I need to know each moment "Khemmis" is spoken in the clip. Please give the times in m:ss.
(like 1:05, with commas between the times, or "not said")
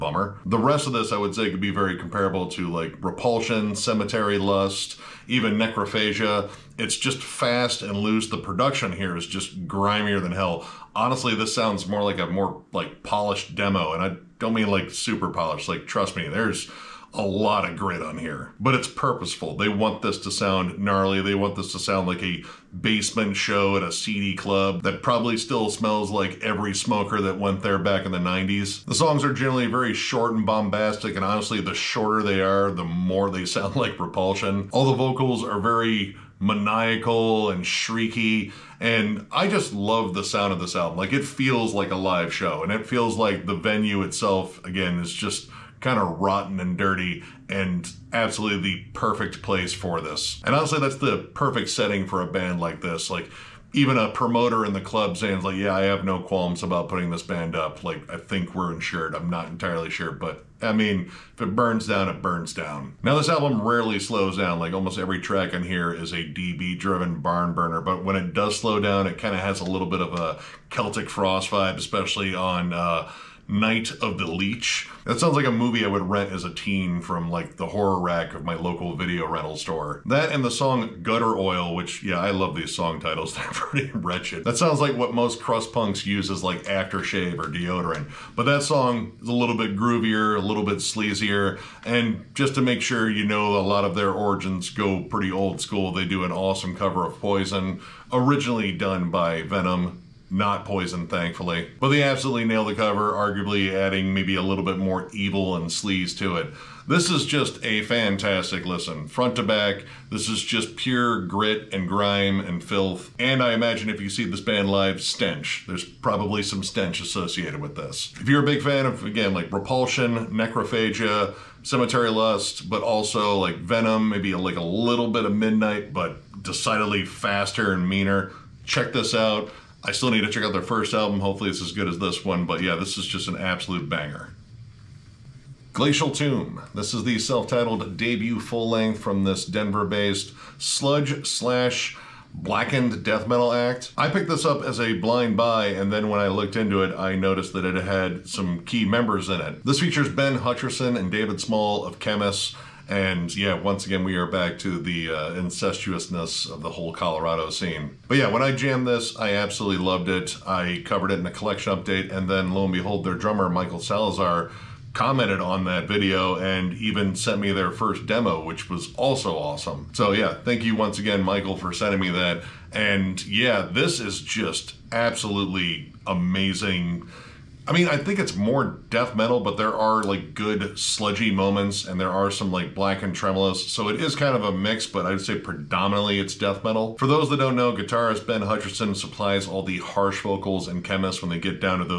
2:31, 3:10.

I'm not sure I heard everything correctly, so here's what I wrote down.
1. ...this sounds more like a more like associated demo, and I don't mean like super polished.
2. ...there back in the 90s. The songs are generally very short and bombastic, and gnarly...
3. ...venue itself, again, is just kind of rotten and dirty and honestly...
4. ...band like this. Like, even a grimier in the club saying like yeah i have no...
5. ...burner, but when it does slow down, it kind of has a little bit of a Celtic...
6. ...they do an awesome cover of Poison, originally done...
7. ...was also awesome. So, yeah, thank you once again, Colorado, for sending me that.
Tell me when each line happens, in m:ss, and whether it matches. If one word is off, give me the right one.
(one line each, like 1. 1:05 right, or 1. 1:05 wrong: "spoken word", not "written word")
1. 0:11 wrong: "polished", not "associated"
2. 0:27 wrong: "honestly", not "gnarly"
3. 0:43 wrong: "absolutely", not "honestly"
4. 0:52 wrong: "promoter", not "grimier"
5. 1:07 right
6. 1:35 right
7. 2:48 wrong: "Michael", not "Colorado".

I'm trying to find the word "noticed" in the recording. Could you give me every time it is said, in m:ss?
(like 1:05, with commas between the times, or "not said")
2:27.